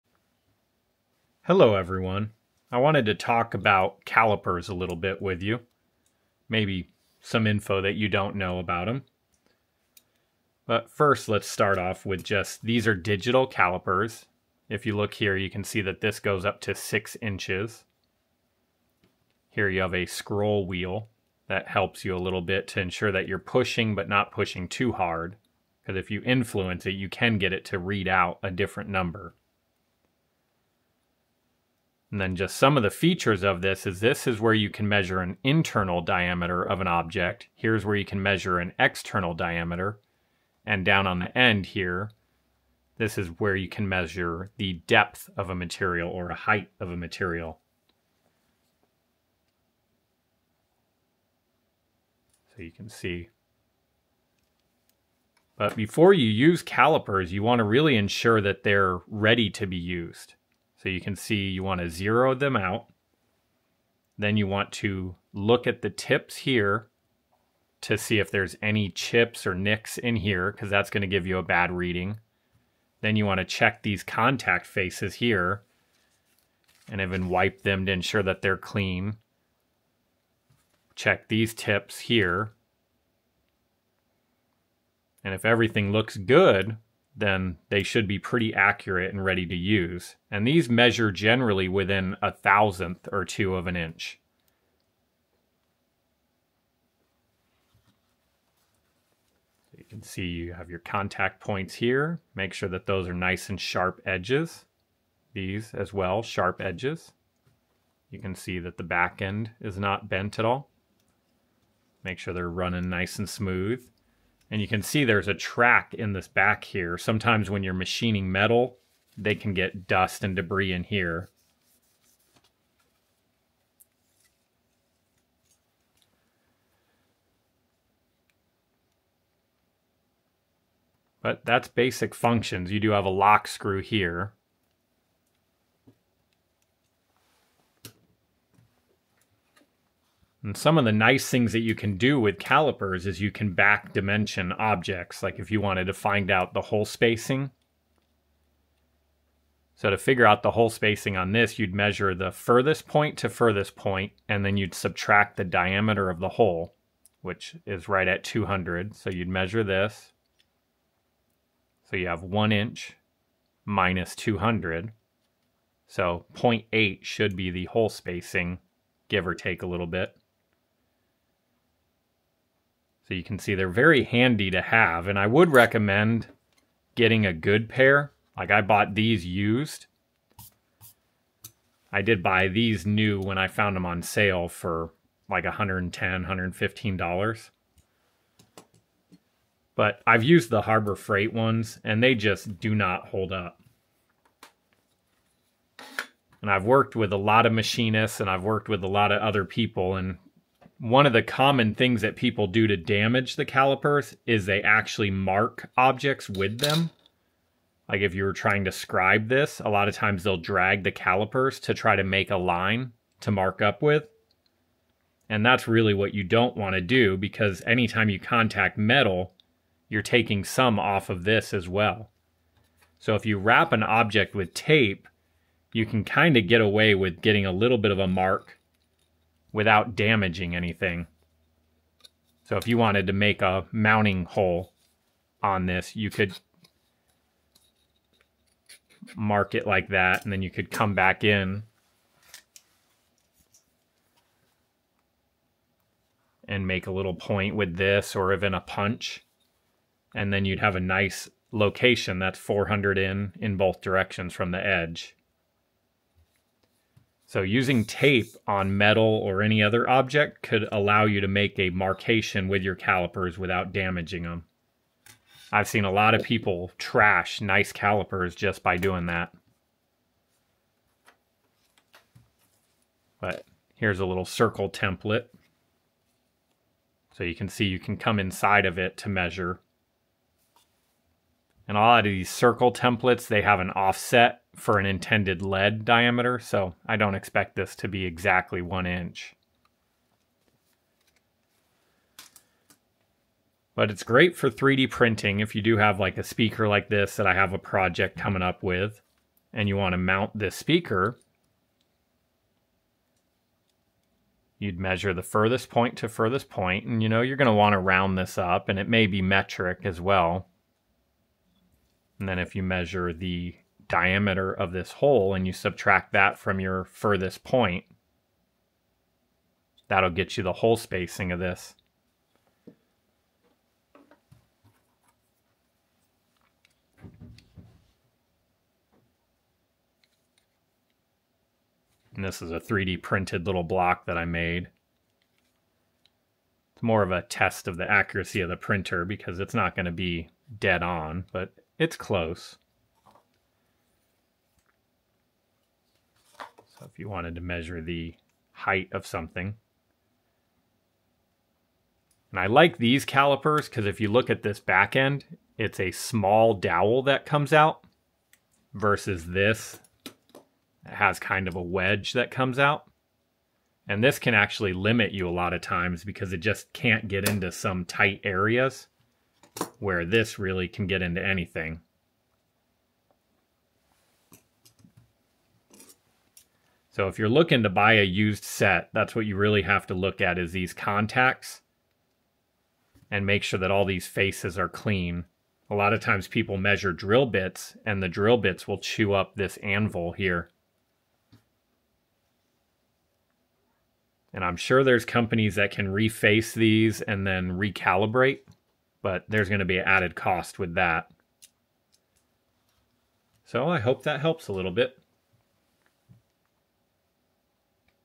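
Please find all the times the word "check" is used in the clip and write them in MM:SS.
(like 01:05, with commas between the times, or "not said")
01:13, 01:20.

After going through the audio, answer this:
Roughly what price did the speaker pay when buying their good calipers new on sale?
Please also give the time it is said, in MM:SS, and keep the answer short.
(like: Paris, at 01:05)
$110 to $115, at 03:05.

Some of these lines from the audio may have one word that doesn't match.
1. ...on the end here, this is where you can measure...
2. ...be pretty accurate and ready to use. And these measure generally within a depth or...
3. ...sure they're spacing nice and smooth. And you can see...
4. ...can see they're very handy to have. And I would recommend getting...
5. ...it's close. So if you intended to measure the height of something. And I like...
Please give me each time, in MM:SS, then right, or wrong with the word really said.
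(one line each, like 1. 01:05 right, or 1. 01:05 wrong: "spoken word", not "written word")
1. 00:41 right
2. 01:28 wrong: "thousandth", not "depth"
3. 01:52 wrong: "running", not "spacing"
4. 02:53 right
5. 05:41 wrong: "wanted", not "intended".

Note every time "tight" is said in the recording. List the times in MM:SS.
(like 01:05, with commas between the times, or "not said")
06:07.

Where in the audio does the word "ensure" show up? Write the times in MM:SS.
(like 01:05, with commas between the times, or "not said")
00:22, 00:57, 01:17.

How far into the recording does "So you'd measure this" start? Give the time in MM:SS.
02:38.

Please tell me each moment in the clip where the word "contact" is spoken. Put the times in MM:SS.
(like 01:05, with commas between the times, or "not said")
01:14, 01:40, 03:38, 06:20.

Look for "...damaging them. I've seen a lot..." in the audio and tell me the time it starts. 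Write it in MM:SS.
04:23.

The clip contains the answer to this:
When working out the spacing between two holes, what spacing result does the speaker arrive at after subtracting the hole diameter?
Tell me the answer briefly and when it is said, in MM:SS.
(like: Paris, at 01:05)
0.8, at 02:46.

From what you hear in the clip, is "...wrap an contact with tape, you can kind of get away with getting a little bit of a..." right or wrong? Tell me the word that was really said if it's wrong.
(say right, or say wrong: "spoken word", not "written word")
wrong: "object", not "contact".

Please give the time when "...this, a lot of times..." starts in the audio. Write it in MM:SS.
03:29.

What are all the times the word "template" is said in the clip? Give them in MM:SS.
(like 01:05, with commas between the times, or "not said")
04:34, 04:42.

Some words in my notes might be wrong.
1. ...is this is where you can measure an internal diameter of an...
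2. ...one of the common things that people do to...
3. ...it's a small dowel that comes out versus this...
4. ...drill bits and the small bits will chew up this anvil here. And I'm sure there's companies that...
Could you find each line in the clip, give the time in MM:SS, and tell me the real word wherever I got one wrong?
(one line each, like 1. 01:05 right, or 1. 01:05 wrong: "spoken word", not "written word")
1. 00:33 right
2. 03:20 right
3. 05:55 right
4. 06:26 wrong: "drill", not "small".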